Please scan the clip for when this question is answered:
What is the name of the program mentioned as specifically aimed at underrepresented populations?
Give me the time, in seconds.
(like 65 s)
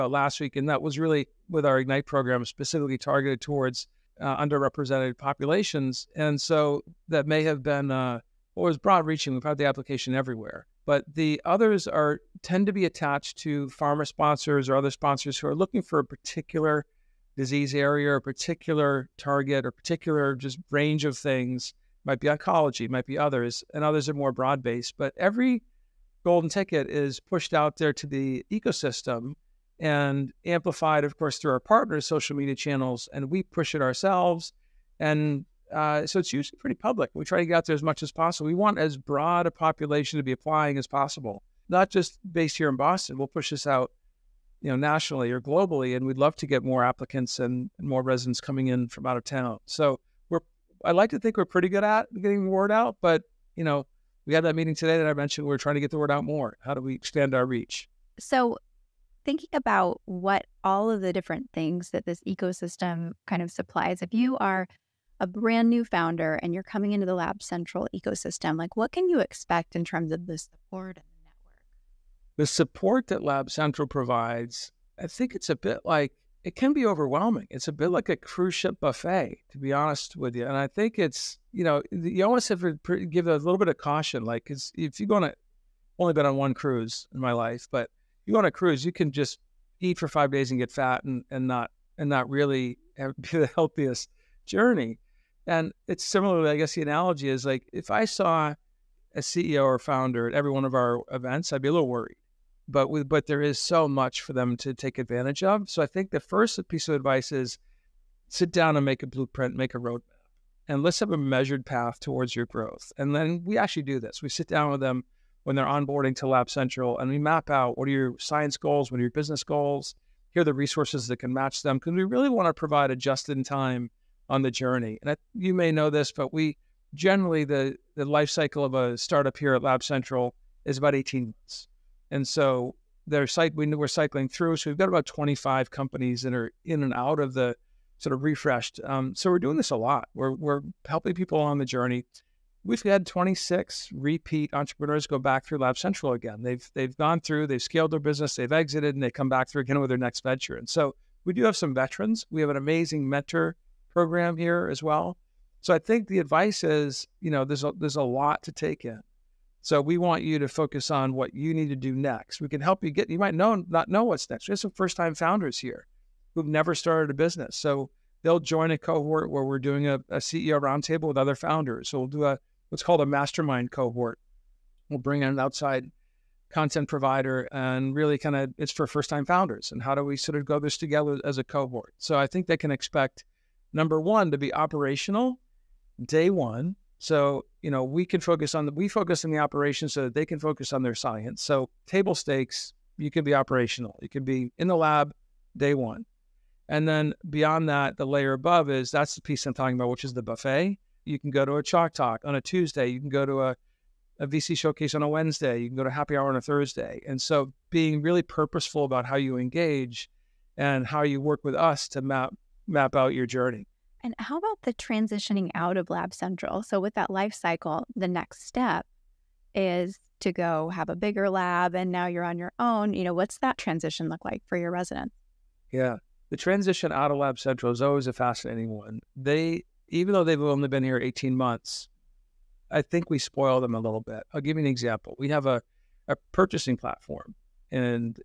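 1 s.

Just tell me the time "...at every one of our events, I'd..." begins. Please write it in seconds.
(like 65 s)
100 s.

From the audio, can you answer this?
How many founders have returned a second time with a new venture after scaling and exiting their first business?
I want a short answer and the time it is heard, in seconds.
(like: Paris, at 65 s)
26, at 143 s.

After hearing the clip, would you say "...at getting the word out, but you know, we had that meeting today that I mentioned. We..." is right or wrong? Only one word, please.
right.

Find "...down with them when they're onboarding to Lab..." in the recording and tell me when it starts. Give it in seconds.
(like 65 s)
114 s.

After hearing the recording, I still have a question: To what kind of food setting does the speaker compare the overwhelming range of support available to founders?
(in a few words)
Cruise ship buffet.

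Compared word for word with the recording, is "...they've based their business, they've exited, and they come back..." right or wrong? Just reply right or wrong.
wrong.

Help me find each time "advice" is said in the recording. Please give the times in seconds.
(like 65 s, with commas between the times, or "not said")
106 s, 156 s.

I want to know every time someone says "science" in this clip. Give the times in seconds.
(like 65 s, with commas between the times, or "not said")
118 s, 190 s.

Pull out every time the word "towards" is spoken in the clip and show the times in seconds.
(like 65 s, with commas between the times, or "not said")
3 s, 111 s.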